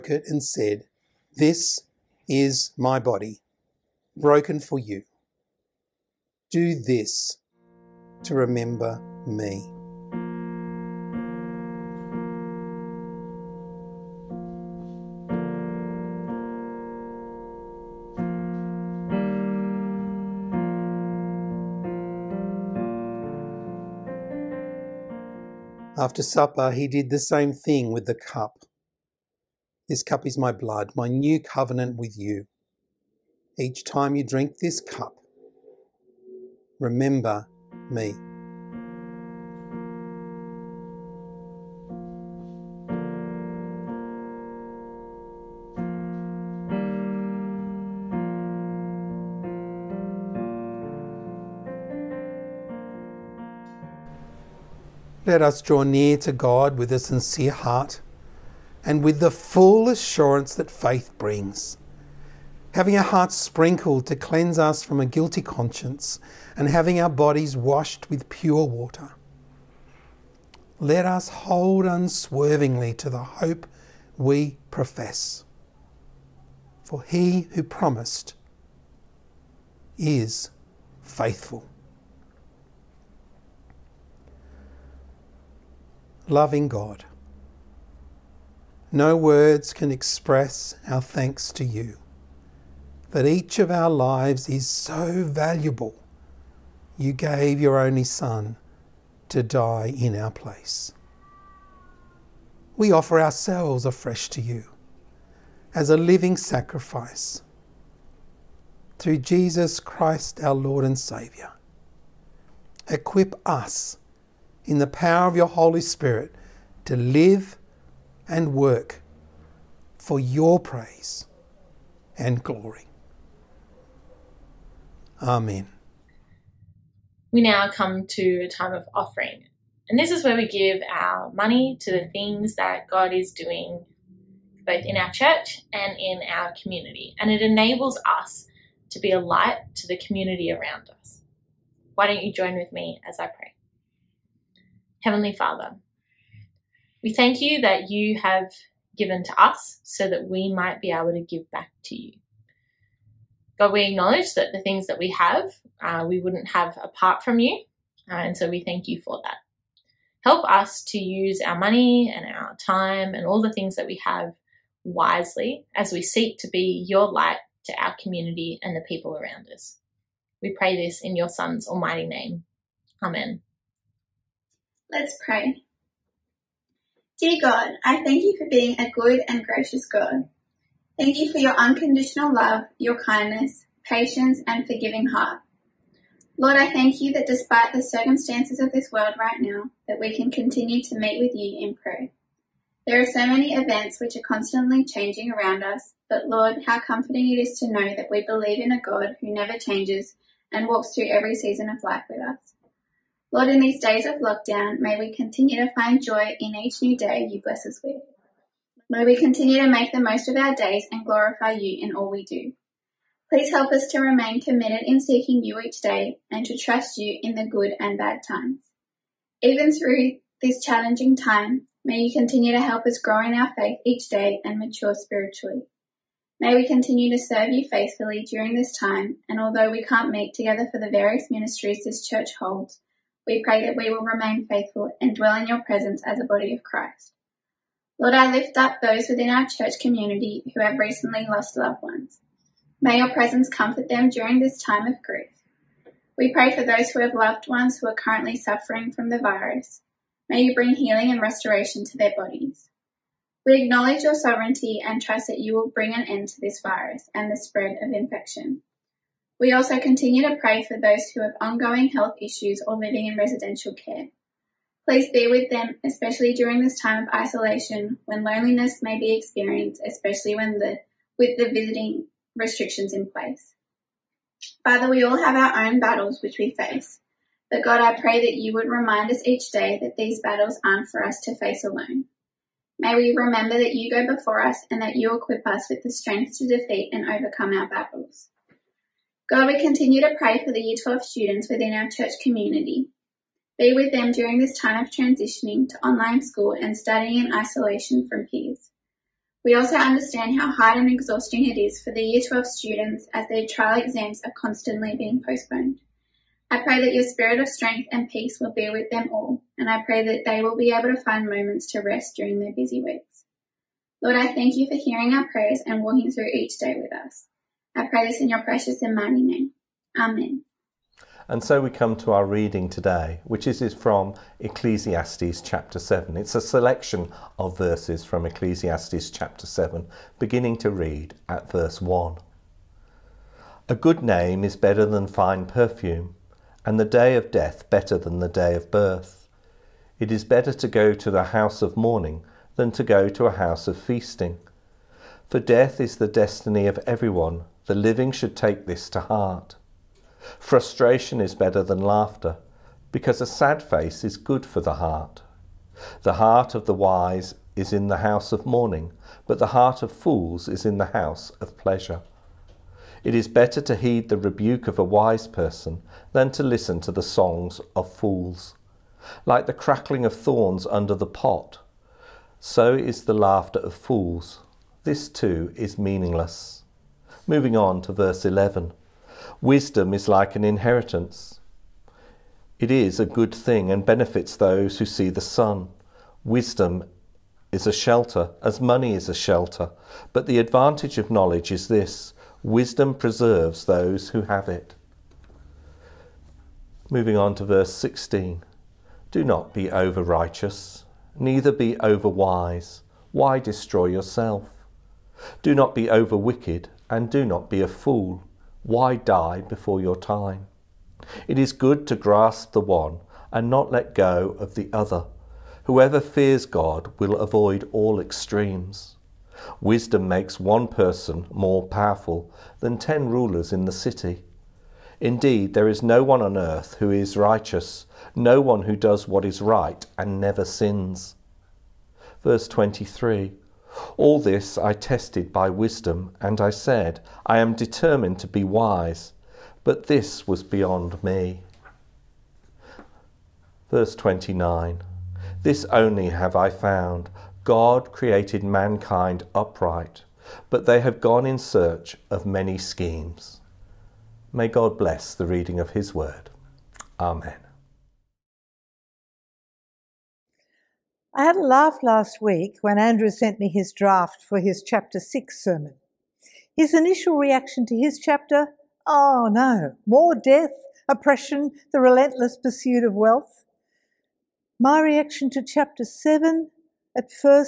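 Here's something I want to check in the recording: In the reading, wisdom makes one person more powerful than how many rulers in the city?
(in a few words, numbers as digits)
10.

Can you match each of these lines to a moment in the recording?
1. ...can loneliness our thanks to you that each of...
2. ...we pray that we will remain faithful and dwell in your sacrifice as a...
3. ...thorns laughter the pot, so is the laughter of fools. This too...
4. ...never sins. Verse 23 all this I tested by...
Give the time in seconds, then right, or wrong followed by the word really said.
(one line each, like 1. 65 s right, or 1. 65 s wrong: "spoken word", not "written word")
1. 89 s wrong: "express", not "loneliness"
2. 233 s wrong: "presence", not "sacrifice"
3. 370 s wrong: "under", not "laughter"
4. 430 s right.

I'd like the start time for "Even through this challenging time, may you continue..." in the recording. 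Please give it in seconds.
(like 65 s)
219 s.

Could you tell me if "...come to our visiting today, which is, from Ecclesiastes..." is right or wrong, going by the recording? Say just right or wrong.
wrong.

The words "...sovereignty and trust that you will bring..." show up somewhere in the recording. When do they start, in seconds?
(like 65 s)
254 s.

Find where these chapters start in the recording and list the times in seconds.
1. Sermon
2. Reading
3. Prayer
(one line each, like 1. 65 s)
1. 457 s
2. 320 s
3. 174 s.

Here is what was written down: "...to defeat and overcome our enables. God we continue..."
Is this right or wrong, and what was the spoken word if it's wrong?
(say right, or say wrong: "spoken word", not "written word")
wrong: "battles", not "enables".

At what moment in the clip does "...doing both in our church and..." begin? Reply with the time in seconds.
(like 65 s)
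133 s.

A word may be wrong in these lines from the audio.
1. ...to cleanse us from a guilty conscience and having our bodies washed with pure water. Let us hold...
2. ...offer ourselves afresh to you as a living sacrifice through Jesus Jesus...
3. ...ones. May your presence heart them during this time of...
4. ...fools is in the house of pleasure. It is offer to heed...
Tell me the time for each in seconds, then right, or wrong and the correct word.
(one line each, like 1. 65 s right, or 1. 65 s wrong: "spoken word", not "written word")
1. 64 s right
2. 102 s wrong: "Christ", not "Jesus"
3. 241 s wrong: "comfort", not "heart"
4. 359 s wrong: "better", not "offer".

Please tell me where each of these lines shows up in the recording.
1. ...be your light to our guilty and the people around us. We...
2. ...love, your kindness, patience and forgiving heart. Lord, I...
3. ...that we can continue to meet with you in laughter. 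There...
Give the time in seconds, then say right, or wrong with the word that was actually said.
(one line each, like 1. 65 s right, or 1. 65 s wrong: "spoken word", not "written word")
1. 166 s wrong: "community", not "guilty"
2. 182 s right
3. 189 s wrong: "prayer", not "laughter".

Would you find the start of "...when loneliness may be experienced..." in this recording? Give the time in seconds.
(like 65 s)
268 s.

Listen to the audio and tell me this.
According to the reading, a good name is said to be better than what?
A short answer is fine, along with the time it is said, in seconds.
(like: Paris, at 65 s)
fine perfume, at 335 s.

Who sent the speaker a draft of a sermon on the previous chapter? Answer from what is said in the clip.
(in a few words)
Andrew.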